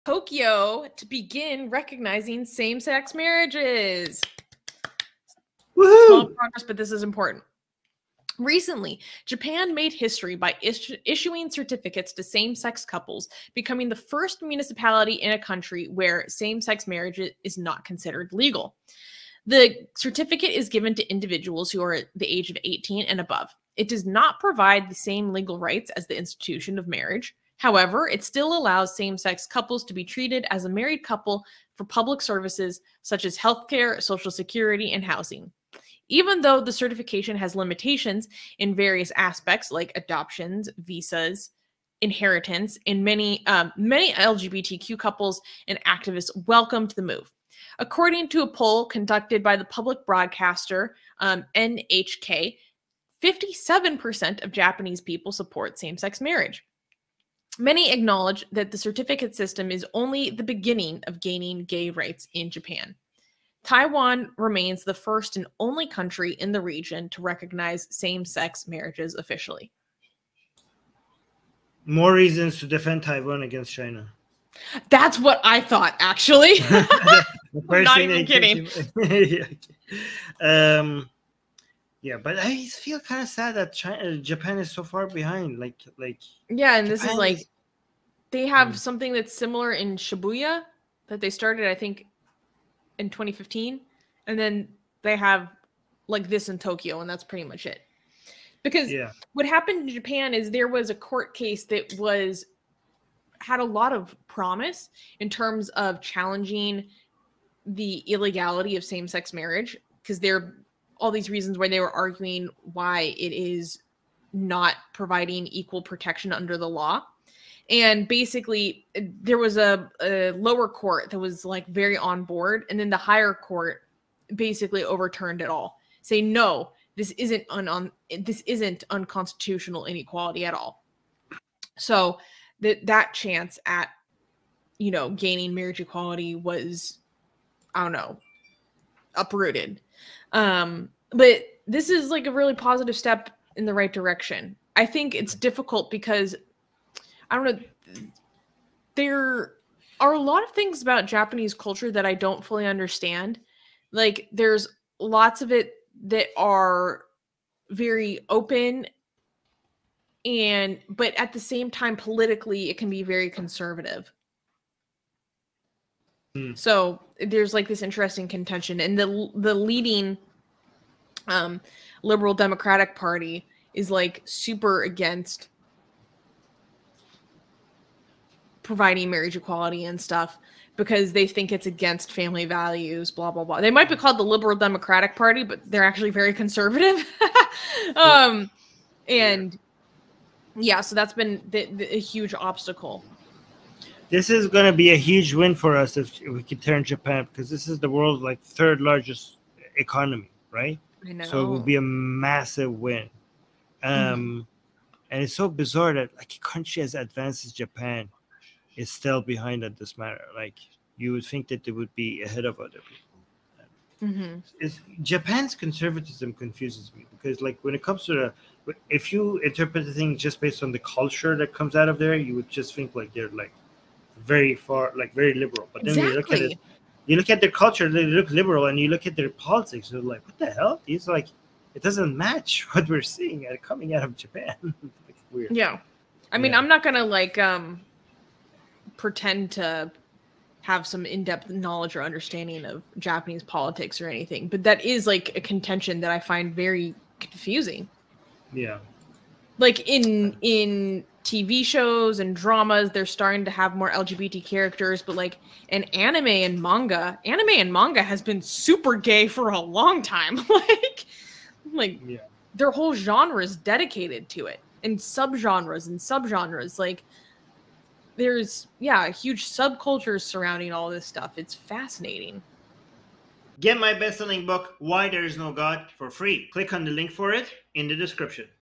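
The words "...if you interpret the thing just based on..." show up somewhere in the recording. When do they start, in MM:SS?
03:38.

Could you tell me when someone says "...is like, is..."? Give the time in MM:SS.
01:27.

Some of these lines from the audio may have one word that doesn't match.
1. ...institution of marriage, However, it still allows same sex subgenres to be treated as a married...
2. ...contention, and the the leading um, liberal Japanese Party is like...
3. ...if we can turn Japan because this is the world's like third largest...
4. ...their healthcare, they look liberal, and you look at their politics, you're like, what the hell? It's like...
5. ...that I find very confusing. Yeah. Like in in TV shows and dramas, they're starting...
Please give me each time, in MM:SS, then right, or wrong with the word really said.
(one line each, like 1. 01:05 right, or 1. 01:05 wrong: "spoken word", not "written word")
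1. 00:26 wrong: "couples", not "subgenres"
2. 02:48 wrong: "Democratic", not "Japanese"
3. 03:16 right
4. 03:47 wrong: "culture", not "healthcare"
5. 04:06 right.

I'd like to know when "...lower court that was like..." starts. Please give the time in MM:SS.
02:00.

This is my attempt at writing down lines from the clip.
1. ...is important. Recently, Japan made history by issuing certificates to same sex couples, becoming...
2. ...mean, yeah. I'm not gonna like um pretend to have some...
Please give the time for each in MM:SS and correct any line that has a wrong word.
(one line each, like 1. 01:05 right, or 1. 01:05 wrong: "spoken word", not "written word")
1. 00:06 right
2. 03:56 right.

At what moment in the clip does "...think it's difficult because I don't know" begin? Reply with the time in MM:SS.
02:24.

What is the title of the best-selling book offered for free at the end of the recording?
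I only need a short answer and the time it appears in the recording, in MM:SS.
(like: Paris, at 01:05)
Why There Is No God, at 04:34.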